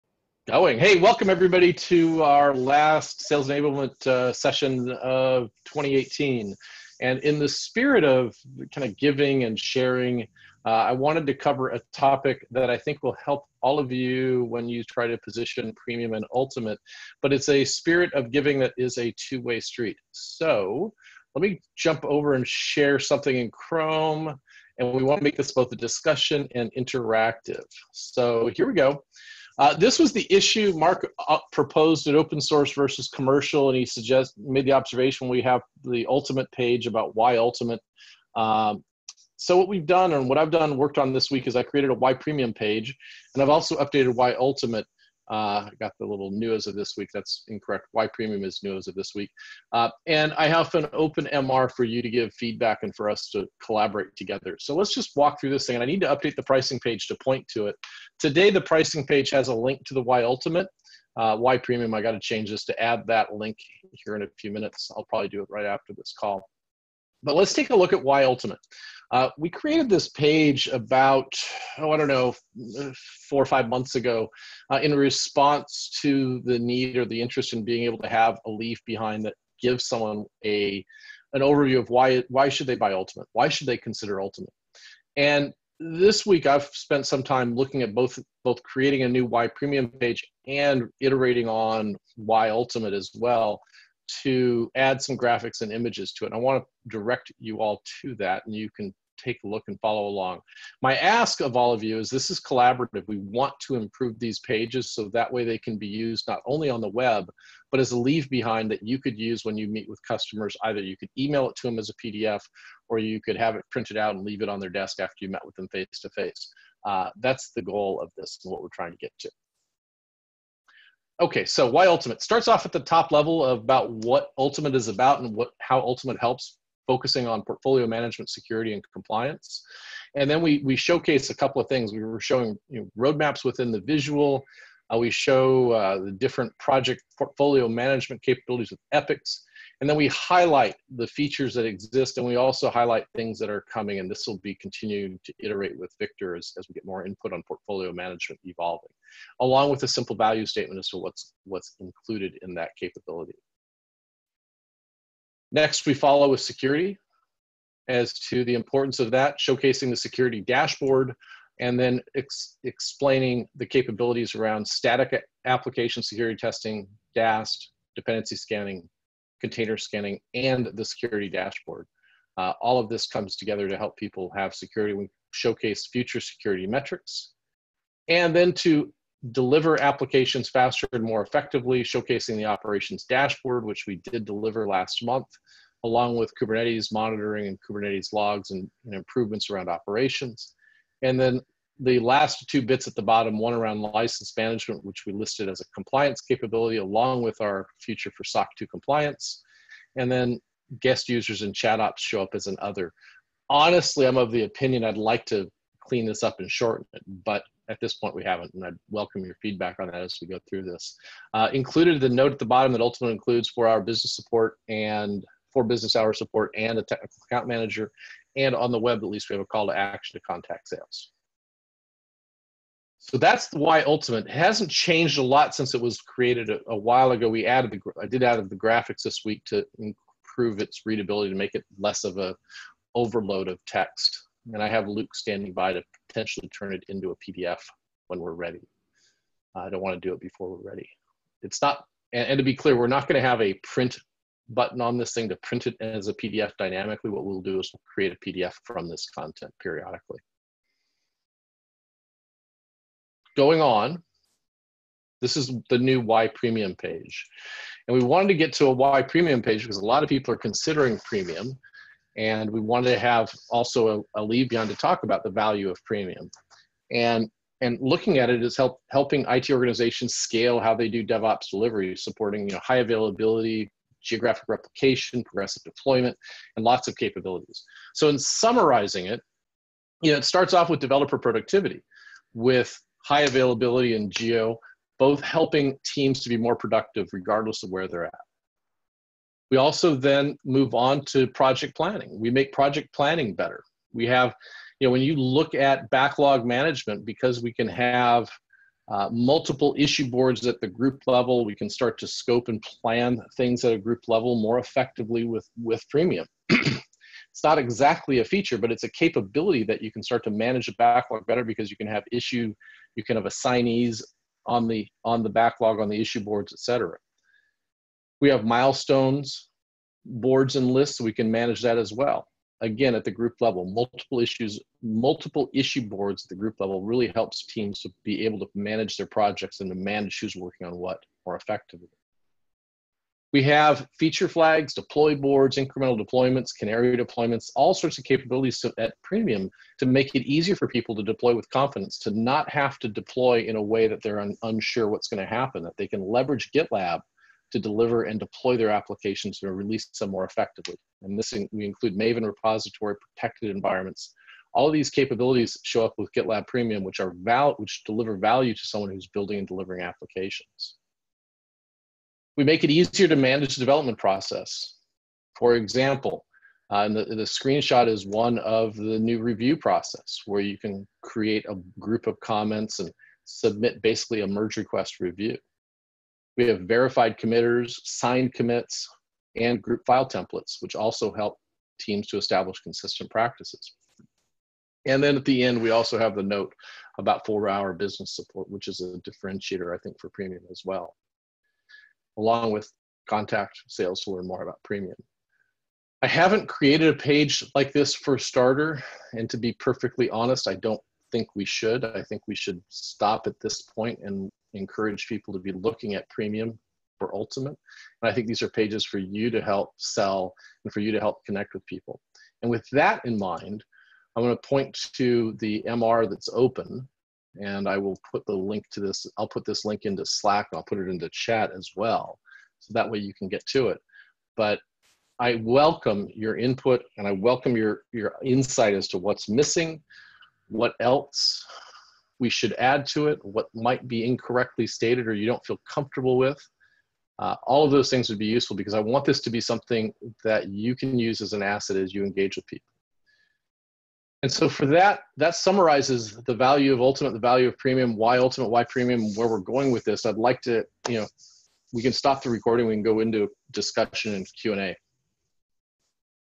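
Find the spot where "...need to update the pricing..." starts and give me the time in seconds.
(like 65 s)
55 s.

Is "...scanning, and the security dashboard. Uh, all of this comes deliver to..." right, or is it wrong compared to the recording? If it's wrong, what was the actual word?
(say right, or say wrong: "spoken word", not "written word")
wrong: "together", not "deliver".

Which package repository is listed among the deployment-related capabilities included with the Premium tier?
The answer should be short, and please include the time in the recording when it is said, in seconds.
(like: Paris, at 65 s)
Maven repository, at 351 s.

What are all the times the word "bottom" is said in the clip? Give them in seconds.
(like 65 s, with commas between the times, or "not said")
193 s, 212 s.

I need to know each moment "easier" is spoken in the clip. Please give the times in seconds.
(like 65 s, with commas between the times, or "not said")
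340 s, 362 s.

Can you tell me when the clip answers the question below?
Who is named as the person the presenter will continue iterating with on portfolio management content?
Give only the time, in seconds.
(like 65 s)
145 s.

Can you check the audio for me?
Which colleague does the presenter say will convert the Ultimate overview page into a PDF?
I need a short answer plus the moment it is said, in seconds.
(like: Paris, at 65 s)
Luke, at 234 s.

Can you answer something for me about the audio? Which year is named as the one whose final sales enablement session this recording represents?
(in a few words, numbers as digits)
2018.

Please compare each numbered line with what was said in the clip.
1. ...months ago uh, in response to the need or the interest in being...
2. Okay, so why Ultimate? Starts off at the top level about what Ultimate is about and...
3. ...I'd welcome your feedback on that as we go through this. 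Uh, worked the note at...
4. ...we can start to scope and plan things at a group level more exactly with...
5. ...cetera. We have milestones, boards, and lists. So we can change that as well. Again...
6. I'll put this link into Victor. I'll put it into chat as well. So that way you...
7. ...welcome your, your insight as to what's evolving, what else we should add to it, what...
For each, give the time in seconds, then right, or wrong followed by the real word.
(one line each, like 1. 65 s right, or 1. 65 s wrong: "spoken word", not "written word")
1. 73 s right
2. 121 s right
3. 208 s wrong: "included", not "worked"
4. 301 s wrong: "effectively", not "exactly"
5. 316 s wrong: "manage", not "change"
6. 419 s wrong: "Slack", not "Victor"
7. 427 s wrong: "missing", not "evolving".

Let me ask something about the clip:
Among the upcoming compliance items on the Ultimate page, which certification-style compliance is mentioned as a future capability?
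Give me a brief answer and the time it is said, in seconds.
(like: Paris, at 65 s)
SOC 2, at 198 s.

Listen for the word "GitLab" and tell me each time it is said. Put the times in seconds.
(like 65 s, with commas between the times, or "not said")
346 s, 356 s.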